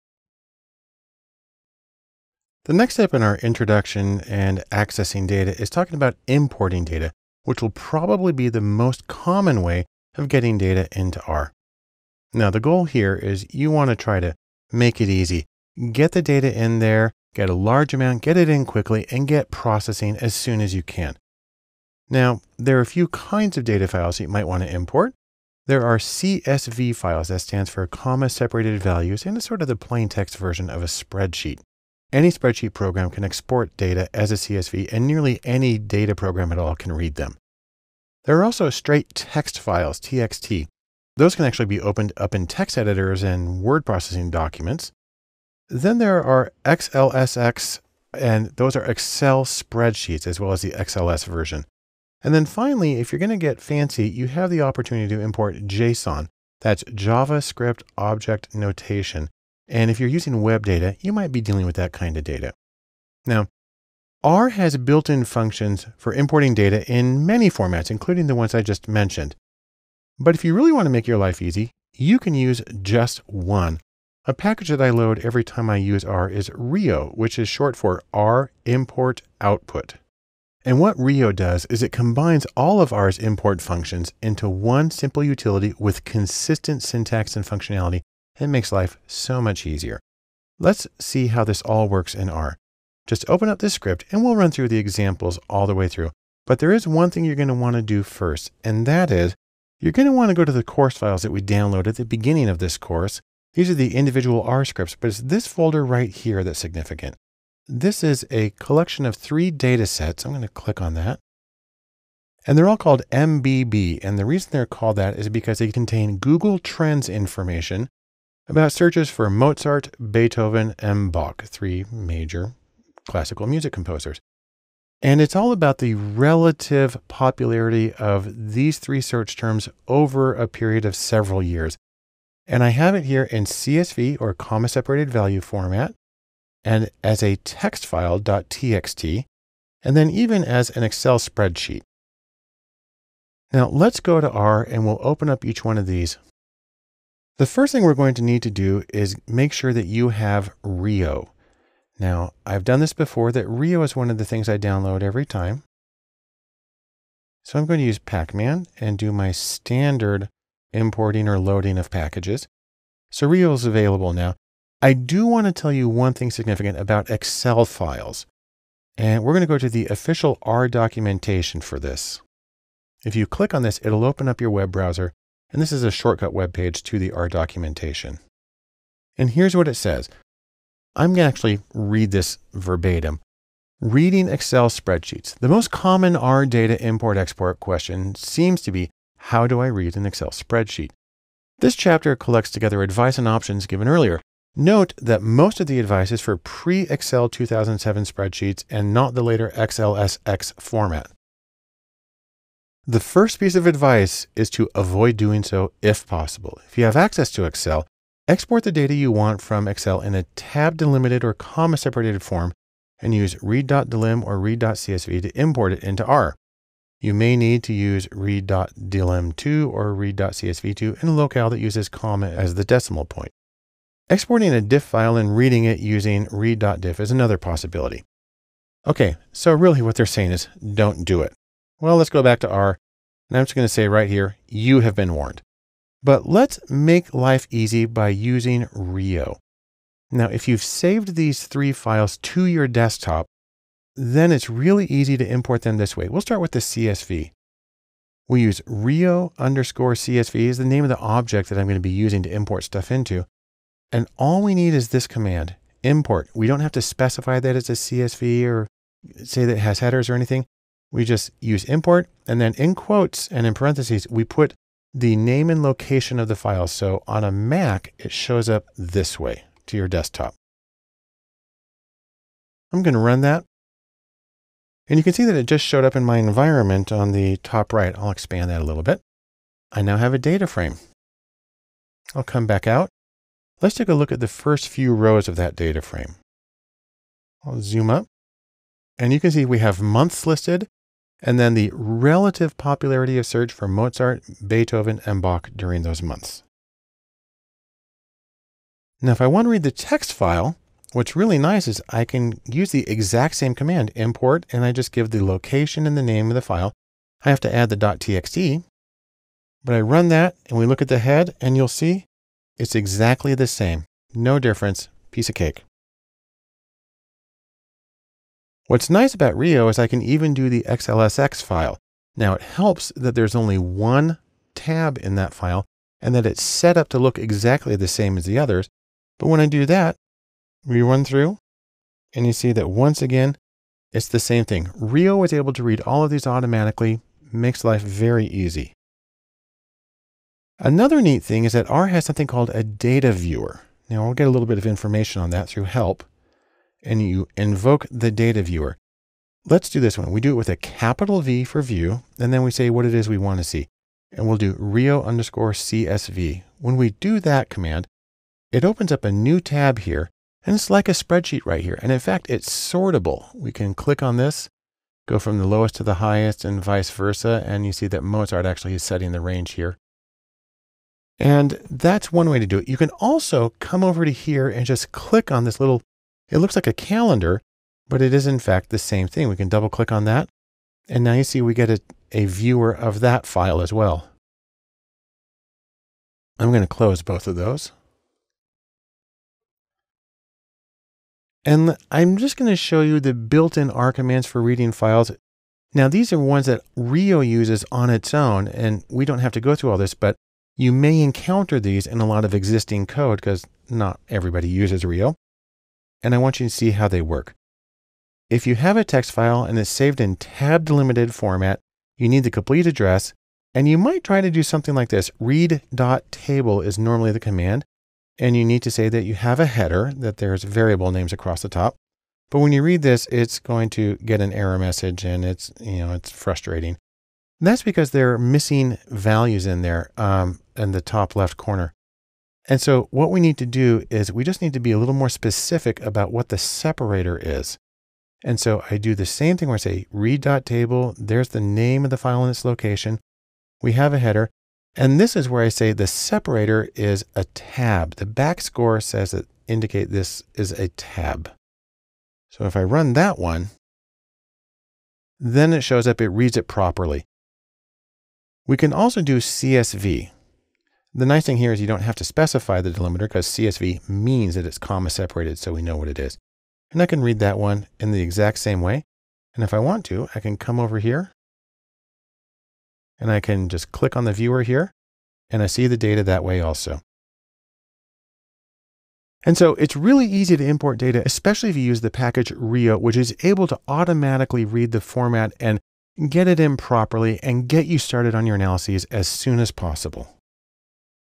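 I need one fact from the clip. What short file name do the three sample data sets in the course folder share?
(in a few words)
MBB.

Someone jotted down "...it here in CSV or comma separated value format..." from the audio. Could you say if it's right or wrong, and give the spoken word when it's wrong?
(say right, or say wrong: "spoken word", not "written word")
right.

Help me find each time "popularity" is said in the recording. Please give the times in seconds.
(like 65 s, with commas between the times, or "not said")
127 s, 292 s.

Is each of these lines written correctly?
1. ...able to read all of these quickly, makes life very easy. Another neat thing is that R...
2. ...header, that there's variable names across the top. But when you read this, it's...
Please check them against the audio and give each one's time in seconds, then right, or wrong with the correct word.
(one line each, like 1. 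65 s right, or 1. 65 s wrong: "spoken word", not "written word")
1. 335 s wrong: "automatically", not "quickly"
2. 419 s right.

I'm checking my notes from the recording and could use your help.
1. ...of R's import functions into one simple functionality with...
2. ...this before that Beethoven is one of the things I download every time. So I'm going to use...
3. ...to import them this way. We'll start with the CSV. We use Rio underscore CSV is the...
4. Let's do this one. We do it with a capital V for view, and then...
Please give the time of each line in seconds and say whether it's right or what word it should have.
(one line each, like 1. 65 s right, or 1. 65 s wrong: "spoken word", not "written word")
1. 82 s wrong: "utility", not "functionality"
2. 152 s wrong: "Rio", not "Beethoven"
3. 245 s right
4. 349 s right.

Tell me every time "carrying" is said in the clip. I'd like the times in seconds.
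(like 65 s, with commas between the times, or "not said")
not said.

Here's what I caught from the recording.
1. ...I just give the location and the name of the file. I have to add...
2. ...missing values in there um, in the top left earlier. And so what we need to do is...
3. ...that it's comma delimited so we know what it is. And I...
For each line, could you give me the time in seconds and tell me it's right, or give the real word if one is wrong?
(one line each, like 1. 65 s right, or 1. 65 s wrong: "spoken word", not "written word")
1. 304 s right
2. 428 s wrong: "corner", not "earlier"
3. 464 s wrong: "separated", not "delimited".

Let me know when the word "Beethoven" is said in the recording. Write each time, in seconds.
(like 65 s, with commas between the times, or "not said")
120 s, 294 s.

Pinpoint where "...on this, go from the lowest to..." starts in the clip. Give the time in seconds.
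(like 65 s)
364 s.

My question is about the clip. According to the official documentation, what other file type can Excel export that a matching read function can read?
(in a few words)
DIF file.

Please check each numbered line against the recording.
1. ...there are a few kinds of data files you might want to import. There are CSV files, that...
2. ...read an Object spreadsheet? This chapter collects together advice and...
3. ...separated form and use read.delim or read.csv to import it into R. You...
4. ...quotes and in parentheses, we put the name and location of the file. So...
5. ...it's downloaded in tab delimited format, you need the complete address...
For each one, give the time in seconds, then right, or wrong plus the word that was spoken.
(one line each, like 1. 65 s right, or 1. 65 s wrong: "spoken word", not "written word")
1. 22 s right
2. 189 s wrong: "Excel", not "Object"
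3. 211 s right
4. 262 s right
5. 409 s wrong: "saved", not "downloaded".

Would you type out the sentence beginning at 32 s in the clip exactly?
Any spreadsheet program can export data as a CSV, and nearly any data program at all can read them.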